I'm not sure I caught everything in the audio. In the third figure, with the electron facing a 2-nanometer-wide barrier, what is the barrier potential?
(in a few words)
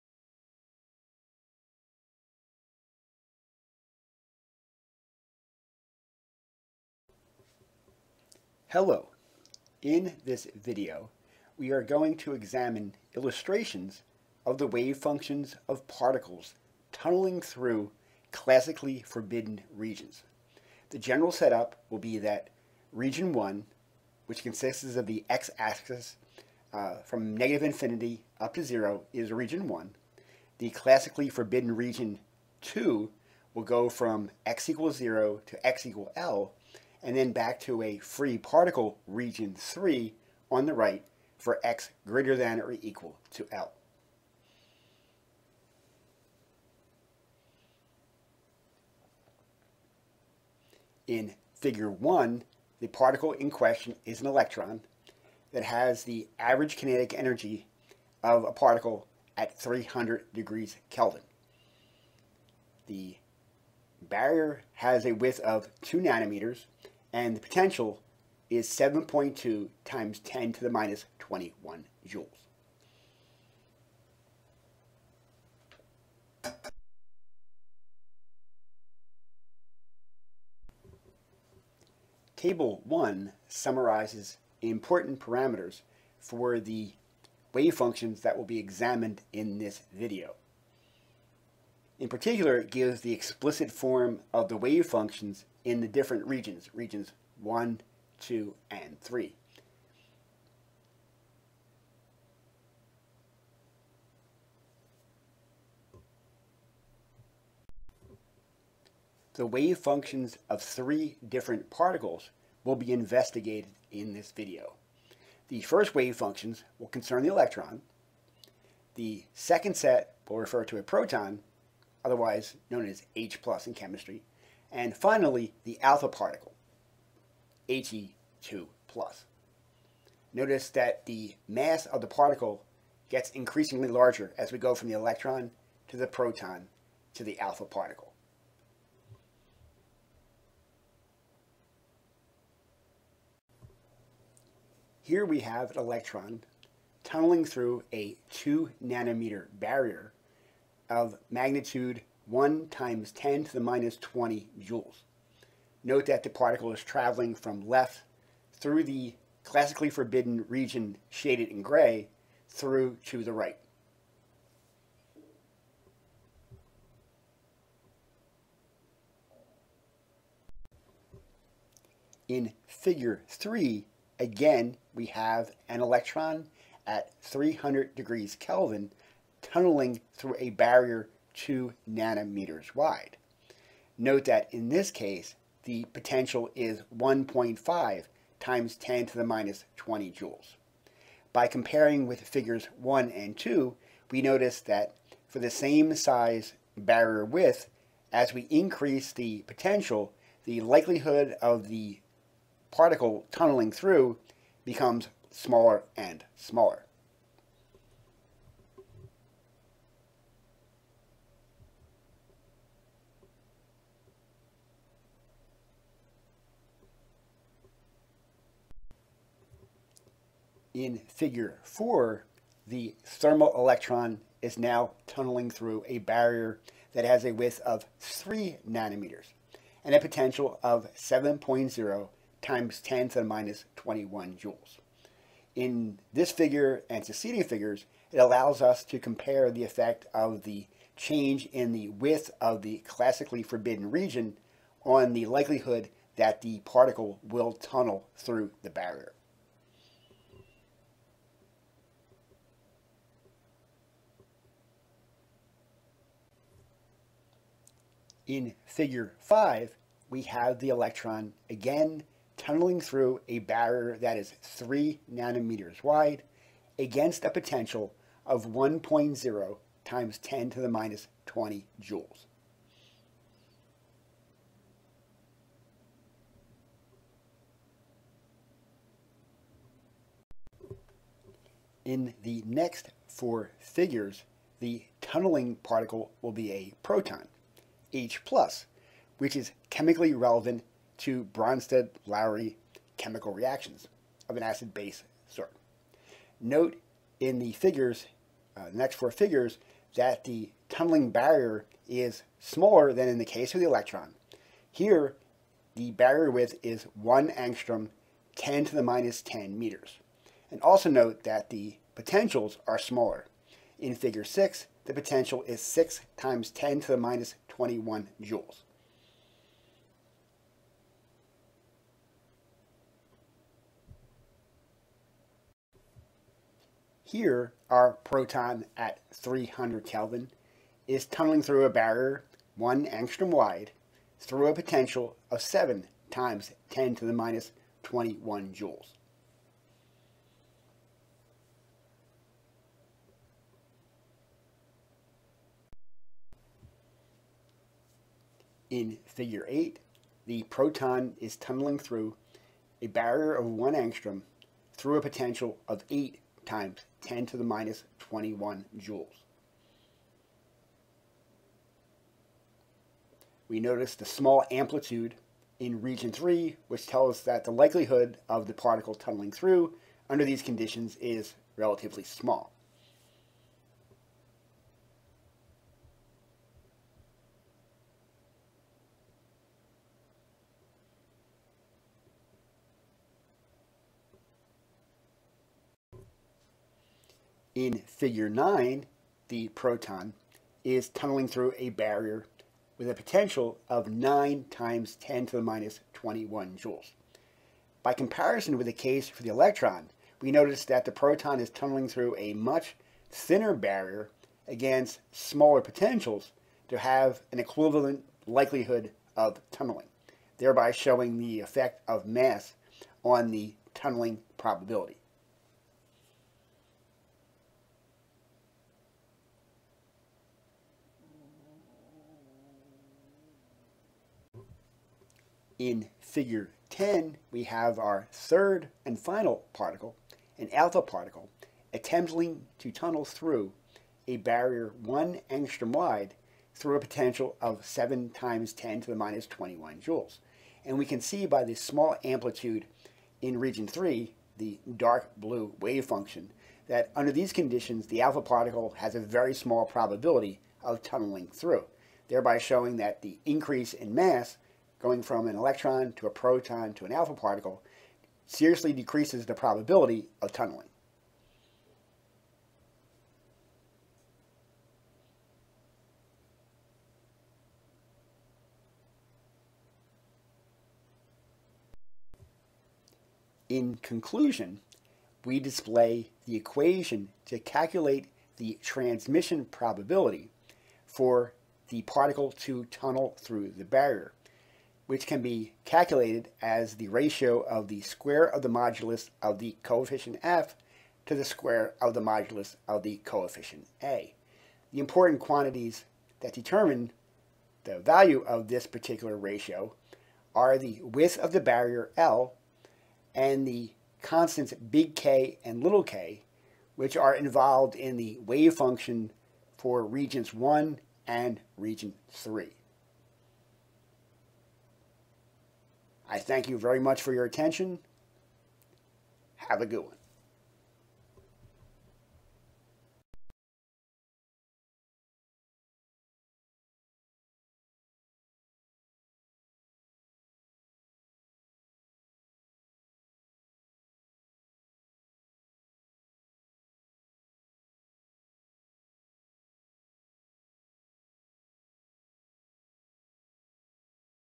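1.5 x 10^-20 joules.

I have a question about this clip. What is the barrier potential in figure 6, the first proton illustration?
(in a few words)
6 x 10^-21 joules.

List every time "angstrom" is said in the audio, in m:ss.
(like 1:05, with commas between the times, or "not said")
5:07, 5:32, 5:53, 7:15.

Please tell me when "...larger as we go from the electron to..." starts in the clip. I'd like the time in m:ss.
2:13.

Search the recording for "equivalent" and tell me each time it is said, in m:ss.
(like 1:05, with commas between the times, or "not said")
6:47.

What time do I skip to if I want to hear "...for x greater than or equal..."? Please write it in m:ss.
0:41.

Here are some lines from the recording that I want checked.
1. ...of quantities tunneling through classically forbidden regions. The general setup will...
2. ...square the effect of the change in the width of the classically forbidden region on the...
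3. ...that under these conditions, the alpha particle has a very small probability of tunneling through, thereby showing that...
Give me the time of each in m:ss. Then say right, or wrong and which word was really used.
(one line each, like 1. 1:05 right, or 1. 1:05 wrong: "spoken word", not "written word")
1. 0:15 wrong: "particles", not "quantities"
2. 3:58 wrong: "compare", not "square"
3. 7:26 right.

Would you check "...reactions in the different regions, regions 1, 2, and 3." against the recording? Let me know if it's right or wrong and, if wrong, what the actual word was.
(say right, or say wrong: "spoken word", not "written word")
wrong: "functions", not "reactions".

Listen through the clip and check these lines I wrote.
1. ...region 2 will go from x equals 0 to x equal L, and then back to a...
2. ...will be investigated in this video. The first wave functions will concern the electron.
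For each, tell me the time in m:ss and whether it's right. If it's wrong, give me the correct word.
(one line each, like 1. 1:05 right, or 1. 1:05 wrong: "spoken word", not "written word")
1. 0:31 right
2. 1:52 right.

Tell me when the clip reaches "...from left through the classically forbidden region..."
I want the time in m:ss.
2:37.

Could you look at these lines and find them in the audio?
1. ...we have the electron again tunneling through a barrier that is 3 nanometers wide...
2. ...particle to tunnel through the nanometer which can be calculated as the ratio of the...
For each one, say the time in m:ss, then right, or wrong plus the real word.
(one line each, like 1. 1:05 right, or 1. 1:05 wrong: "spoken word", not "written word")
1. 4:20 right
2. 8:01 wrong: "barrier", not "nanometer".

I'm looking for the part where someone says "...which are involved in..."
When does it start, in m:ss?
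8:26.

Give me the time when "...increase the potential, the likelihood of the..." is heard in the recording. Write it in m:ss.
3:18.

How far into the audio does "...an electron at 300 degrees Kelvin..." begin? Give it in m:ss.
2:55.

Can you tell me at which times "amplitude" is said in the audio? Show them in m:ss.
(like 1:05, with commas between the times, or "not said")
6:04, 7:22.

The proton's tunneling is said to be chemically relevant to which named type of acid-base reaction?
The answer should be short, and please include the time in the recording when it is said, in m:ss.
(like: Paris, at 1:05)
Bronsted-Lowry, at 4:51.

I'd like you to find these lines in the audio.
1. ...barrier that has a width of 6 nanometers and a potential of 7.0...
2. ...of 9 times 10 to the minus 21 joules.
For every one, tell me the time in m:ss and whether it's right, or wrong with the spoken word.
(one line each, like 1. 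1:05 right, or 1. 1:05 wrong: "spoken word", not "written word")
1. 3:45 wrong: "3", not "6"
2. 6:33 right.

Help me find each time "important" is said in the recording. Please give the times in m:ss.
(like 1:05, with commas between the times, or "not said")
1:24, 8:14.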